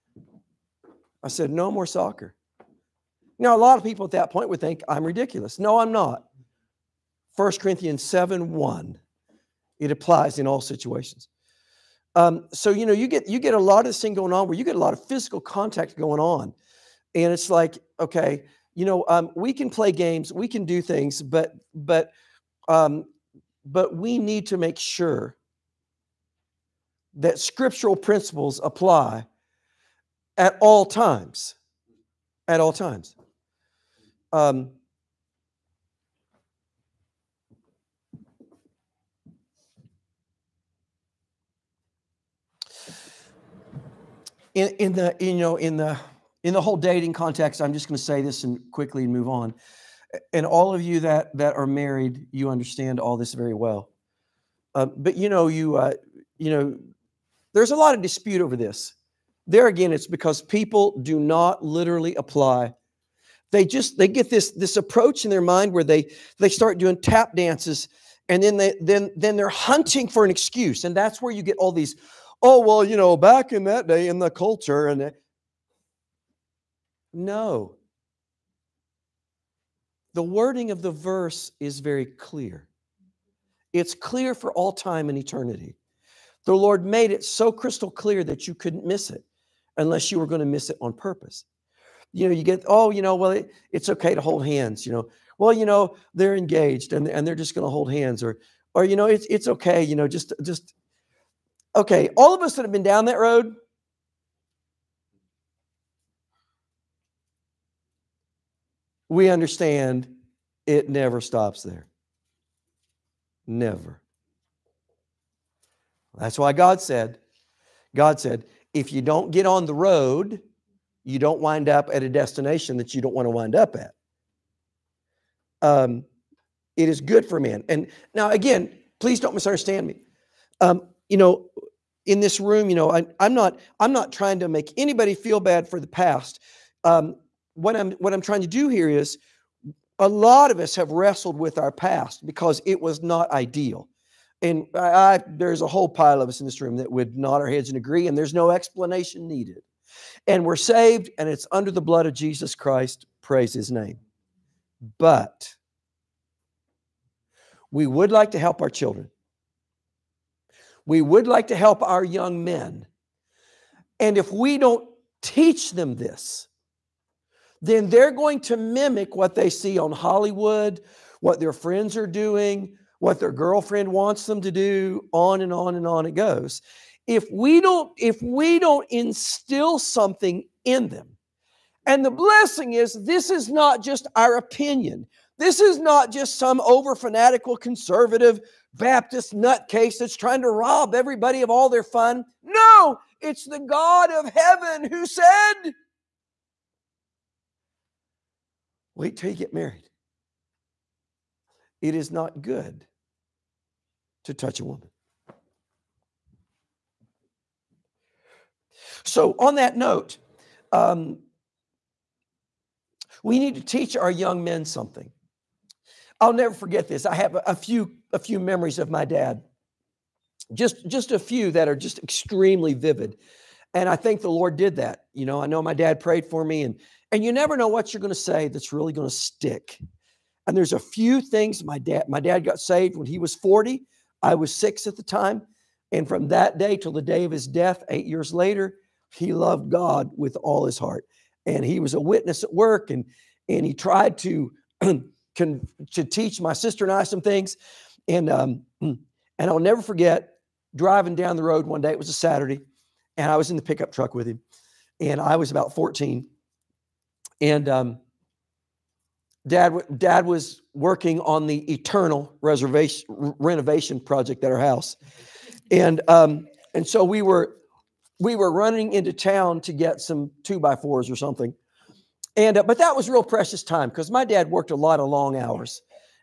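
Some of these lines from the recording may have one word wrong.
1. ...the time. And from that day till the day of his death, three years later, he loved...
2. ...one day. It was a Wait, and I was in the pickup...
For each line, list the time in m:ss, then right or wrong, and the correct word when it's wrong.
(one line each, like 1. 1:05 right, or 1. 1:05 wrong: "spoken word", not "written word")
1. 3:54 wrong: "eight", not "three"
2. 4:11 wrong: "Saturday", not "Wait".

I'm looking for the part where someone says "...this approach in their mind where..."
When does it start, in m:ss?
1:04.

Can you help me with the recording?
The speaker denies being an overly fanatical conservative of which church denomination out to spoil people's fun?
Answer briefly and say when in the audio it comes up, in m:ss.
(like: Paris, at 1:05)
Baptist, at 3:08.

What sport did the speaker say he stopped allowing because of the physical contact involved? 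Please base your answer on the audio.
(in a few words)
Soccer.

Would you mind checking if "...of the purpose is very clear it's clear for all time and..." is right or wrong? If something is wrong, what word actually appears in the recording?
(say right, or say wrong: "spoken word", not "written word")
wrong: "verse", not "purpose".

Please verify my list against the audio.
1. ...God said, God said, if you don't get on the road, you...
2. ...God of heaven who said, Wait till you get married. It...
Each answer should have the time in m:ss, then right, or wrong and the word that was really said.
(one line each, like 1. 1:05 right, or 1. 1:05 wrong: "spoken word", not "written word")
1. 1:56 right
2. 3:13 right.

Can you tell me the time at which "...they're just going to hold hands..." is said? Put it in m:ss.
1:37.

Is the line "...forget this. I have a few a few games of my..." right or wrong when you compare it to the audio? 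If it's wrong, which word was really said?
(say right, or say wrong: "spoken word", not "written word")
wrong: "memories", not "games".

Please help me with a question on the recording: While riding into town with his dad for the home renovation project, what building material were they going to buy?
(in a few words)
Two by fours.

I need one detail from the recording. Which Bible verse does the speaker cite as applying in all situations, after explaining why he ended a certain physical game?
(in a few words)
1 Corinthians 7:1.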